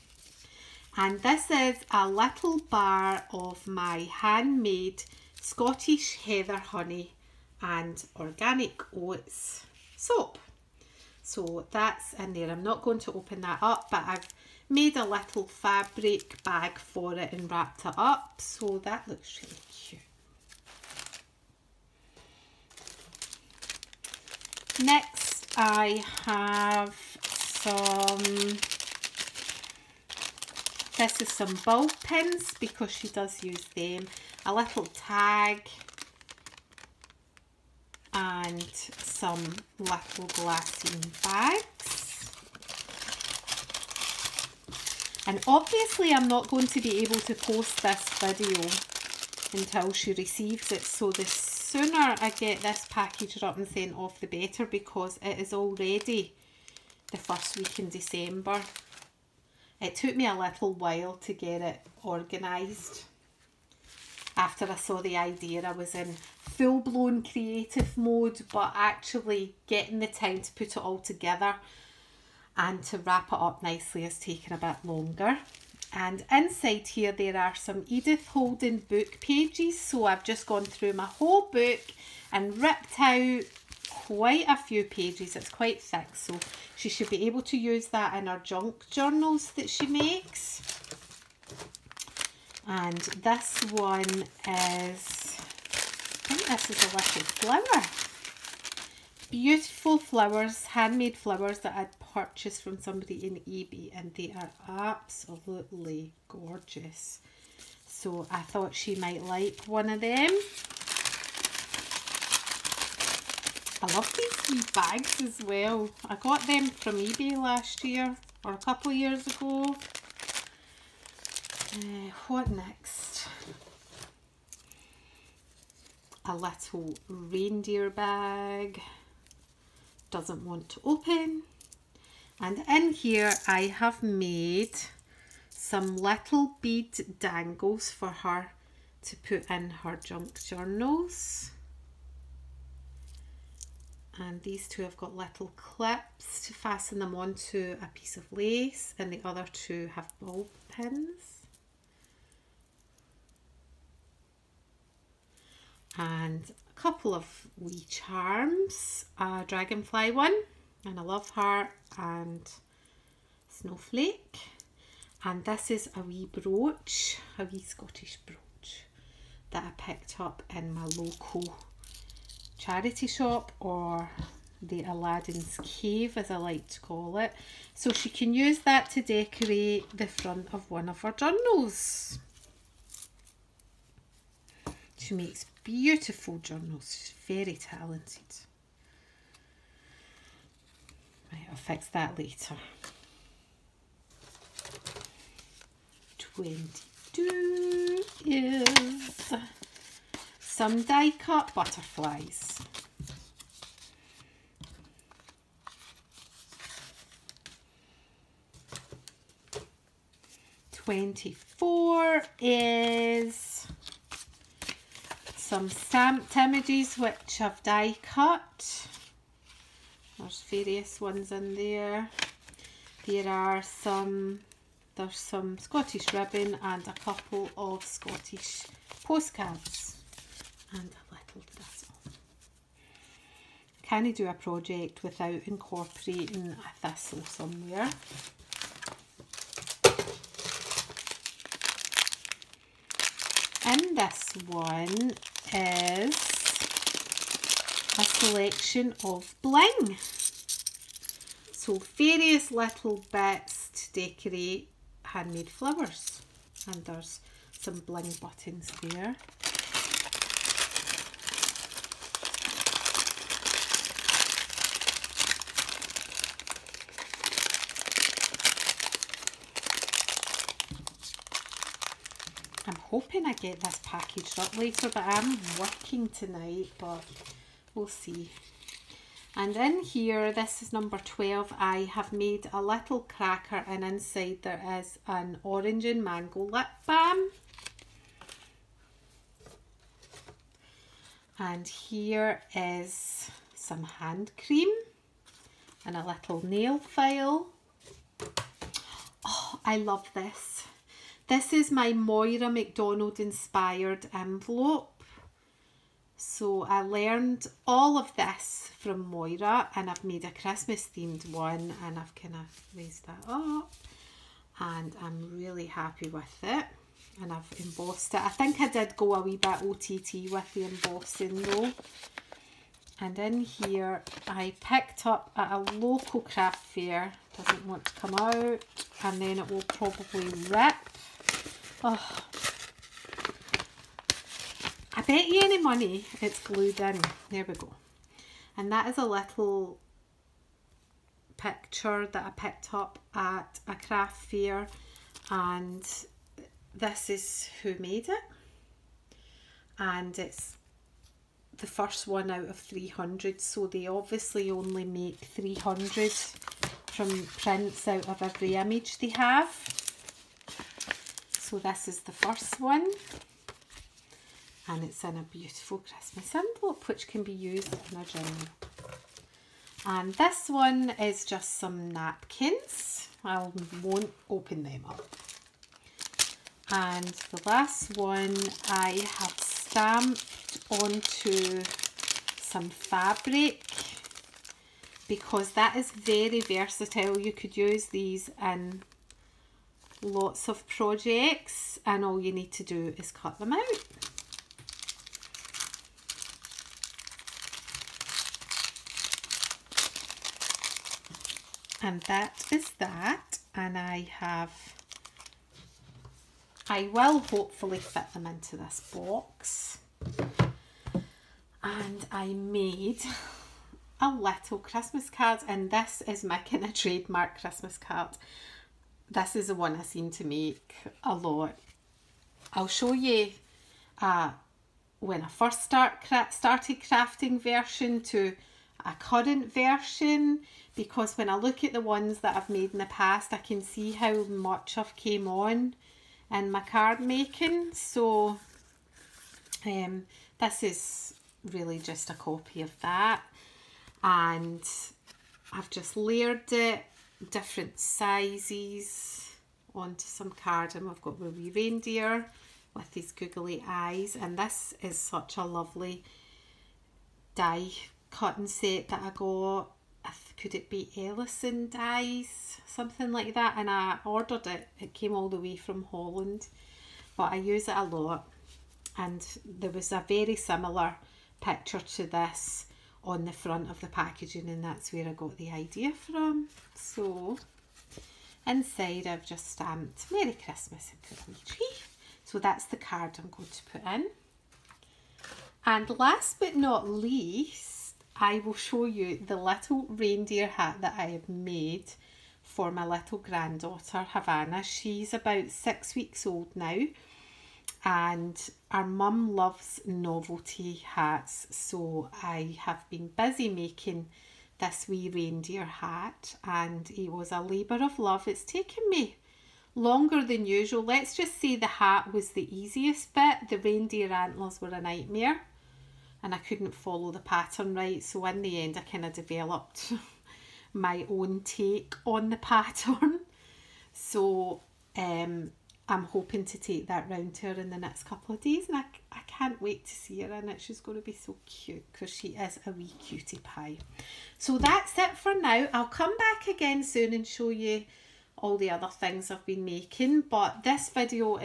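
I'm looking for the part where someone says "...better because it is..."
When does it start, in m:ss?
0:54.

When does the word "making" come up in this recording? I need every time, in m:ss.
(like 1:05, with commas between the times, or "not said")
7:16, 8:23, 8:59.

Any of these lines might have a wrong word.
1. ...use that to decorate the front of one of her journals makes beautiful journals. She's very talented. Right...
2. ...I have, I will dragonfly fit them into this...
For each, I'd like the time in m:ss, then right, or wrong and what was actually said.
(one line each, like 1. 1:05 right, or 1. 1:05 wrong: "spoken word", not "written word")
1. 2:58 right
2. 6:43 wrong: "hopefully", not "dragonfly".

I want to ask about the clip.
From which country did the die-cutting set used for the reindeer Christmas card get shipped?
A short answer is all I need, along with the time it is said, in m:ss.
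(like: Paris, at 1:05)
Holland, at 7:45.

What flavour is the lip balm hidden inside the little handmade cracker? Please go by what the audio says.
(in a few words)
orange and mango.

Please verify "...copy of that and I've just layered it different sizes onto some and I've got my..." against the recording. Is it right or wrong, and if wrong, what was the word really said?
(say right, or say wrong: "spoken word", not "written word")
right.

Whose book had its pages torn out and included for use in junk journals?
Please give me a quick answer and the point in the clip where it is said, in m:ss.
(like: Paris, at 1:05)
Edith Holden, at 1:17.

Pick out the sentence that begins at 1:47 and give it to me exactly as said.
So I thought she might like one of them.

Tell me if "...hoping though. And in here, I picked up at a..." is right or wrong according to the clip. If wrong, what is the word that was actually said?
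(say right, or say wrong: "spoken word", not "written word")
wrong: "embossing", not "hoping".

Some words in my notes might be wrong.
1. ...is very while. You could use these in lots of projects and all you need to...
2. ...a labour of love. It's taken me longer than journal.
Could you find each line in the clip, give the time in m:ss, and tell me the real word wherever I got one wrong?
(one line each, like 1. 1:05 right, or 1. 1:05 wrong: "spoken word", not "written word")
1. 6:25 wrong: "versatile", not "while"
2. 8:27 wrong: "usual", not "journal".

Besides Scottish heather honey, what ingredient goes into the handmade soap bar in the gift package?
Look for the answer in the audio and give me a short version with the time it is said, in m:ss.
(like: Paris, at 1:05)
organic oats, at 0:08.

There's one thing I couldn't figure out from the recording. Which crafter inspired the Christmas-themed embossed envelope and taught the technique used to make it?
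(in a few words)
Moira McDonald.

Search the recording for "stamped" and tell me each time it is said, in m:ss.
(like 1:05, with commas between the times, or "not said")
3:35, 6:19, 7:59.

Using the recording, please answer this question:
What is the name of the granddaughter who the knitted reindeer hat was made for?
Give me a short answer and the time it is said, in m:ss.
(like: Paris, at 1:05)
Havana, at 8:14.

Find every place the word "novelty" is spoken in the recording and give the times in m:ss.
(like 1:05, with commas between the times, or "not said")
8:19.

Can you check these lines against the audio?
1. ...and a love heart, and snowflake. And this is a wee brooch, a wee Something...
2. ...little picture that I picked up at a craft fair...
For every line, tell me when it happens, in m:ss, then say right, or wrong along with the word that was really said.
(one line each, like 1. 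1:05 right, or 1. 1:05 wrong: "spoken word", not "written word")
1. 2:40 wrong: "Scottish", not "Something"
2. 5:39 right.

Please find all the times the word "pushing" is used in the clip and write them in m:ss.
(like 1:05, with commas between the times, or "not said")
not said.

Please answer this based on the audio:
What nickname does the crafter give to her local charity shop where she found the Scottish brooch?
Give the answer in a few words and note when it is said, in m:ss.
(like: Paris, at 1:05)
Aladdin's Cave, at 2:54.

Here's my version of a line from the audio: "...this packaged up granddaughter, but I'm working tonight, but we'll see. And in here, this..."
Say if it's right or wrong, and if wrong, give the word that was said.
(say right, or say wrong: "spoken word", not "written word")
wrong: "later", not "granddaughter".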